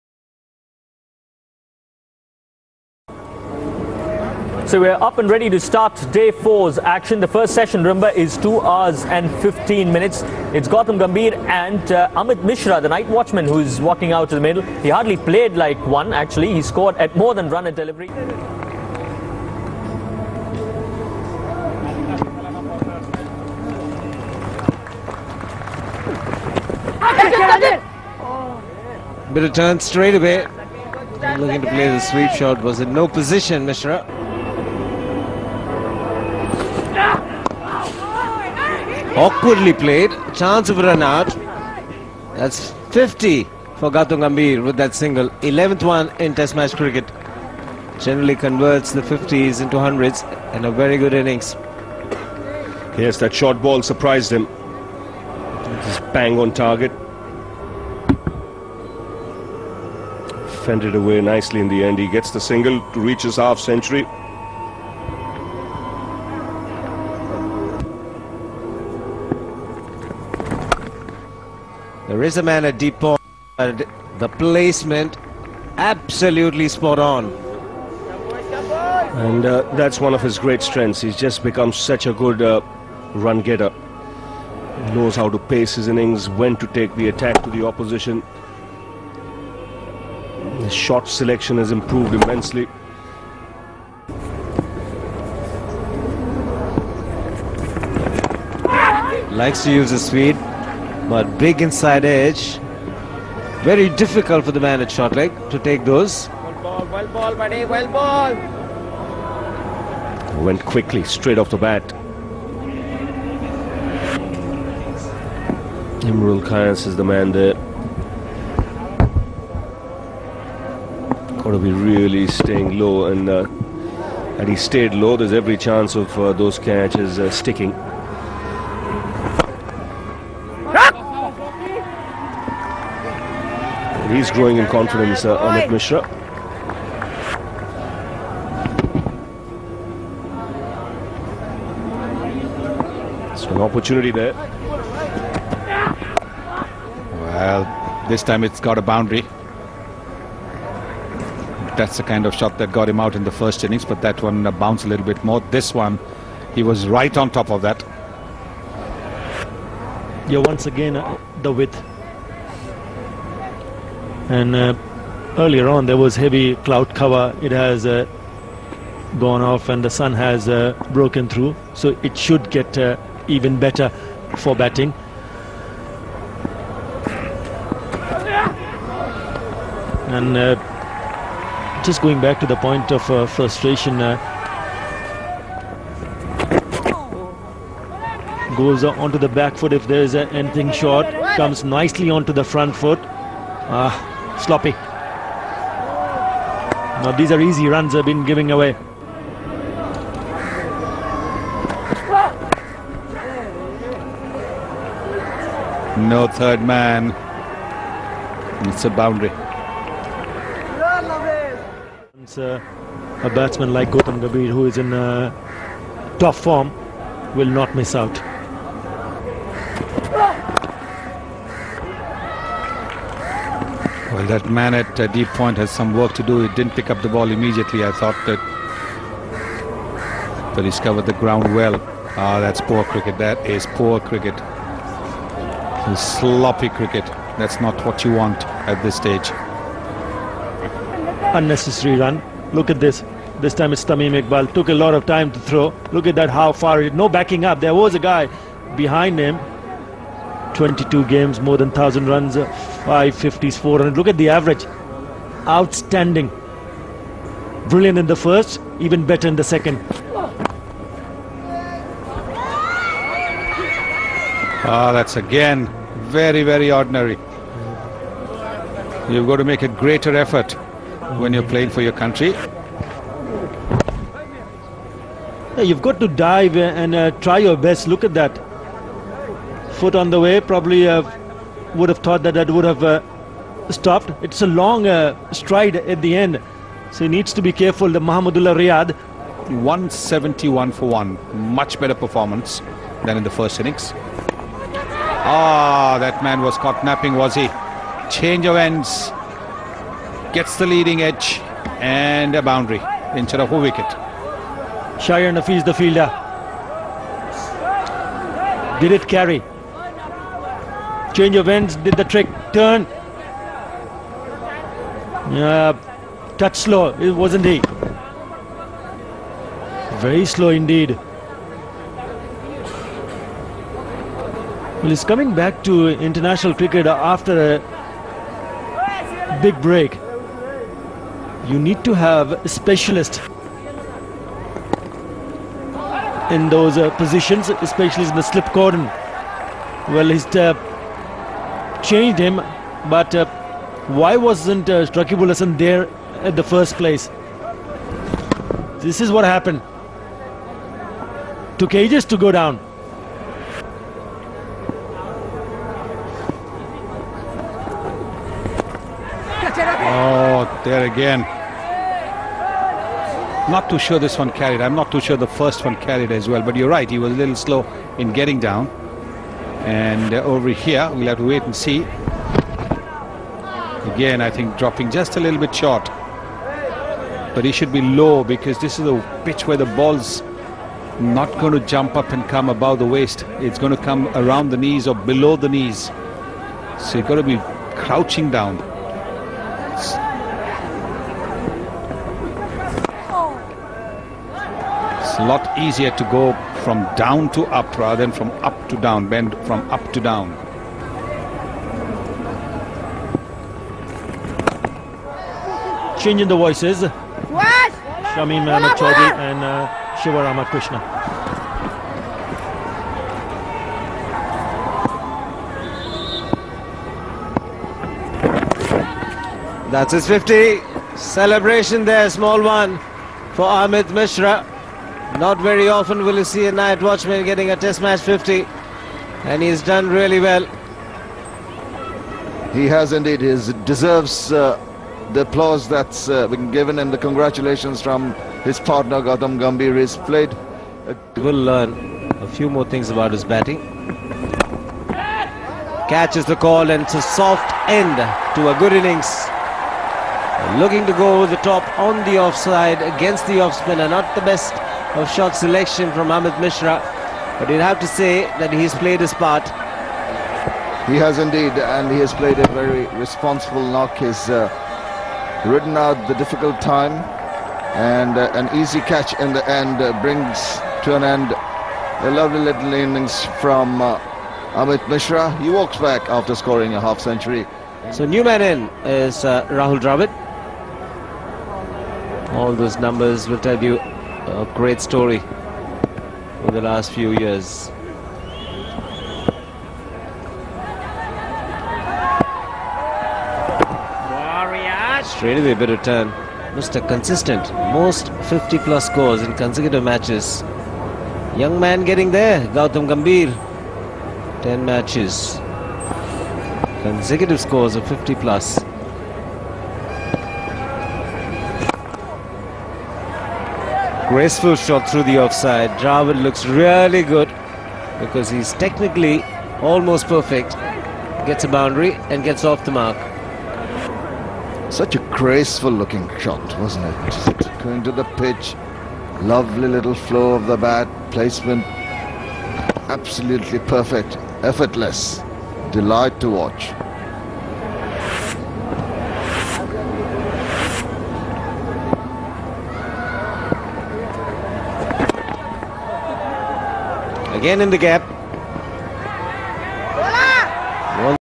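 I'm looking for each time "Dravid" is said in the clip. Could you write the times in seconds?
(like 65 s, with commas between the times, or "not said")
479 s, 515 s.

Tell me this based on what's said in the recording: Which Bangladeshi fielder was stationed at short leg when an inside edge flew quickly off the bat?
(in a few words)
Imrul Khan.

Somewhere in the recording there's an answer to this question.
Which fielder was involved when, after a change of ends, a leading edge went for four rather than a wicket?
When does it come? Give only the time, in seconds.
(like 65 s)
305 s.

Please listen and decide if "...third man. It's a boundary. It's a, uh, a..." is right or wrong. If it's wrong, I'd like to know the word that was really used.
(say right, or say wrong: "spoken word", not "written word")
right.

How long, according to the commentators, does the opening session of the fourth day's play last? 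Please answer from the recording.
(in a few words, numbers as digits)
2 hours 15 minutes.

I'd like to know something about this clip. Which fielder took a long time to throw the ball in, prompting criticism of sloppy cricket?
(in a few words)
Tamim Iqbal.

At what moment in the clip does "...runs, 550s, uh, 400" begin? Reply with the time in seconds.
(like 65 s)
252 s.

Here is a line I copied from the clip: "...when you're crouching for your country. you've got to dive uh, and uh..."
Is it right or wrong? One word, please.
wrong.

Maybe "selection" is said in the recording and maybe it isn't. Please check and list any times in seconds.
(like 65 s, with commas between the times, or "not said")
91 s, 455 s.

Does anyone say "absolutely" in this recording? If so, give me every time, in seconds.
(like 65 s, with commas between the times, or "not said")
75 s, 532 s.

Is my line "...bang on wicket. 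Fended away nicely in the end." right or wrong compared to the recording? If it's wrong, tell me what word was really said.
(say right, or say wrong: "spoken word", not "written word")
wrong: "target", not "wicket".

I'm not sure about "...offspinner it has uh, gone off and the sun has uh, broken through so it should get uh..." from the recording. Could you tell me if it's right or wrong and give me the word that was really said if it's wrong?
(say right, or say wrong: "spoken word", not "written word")
wrong: "cover", not "offspinner".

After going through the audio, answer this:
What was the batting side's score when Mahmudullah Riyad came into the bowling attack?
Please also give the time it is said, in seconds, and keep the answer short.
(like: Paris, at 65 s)
171 for 1, at 289 s.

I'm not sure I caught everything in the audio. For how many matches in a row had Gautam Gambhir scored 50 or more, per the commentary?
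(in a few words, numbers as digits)
10.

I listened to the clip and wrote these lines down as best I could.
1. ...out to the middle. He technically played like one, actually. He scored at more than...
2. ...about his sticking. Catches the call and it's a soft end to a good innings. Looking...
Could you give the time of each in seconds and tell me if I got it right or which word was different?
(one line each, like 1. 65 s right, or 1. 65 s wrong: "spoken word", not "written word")
1. 14 s wrong: "hardly", not "technically"
2. 442 s wrong: "batting", not "sticking".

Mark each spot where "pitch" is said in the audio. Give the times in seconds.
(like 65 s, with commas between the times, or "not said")
379 s, 528 s.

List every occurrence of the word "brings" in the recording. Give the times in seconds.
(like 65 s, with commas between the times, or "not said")
470 s.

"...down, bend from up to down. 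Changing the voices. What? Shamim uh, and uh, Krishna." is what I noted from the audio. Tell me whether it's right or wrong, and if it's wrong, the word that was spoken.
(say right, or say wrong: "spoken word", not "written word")
right.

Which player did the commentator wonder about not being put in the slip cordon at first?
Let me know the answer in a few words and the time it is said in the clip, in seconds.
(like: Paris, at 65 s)
Raqibul Hasan, at 344 s.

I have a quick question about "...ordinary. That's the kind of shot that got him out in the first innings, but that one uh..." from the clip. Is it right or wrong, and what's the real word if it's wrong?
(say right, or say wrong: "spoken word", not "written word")
wrong: "boundary", not "ordinary".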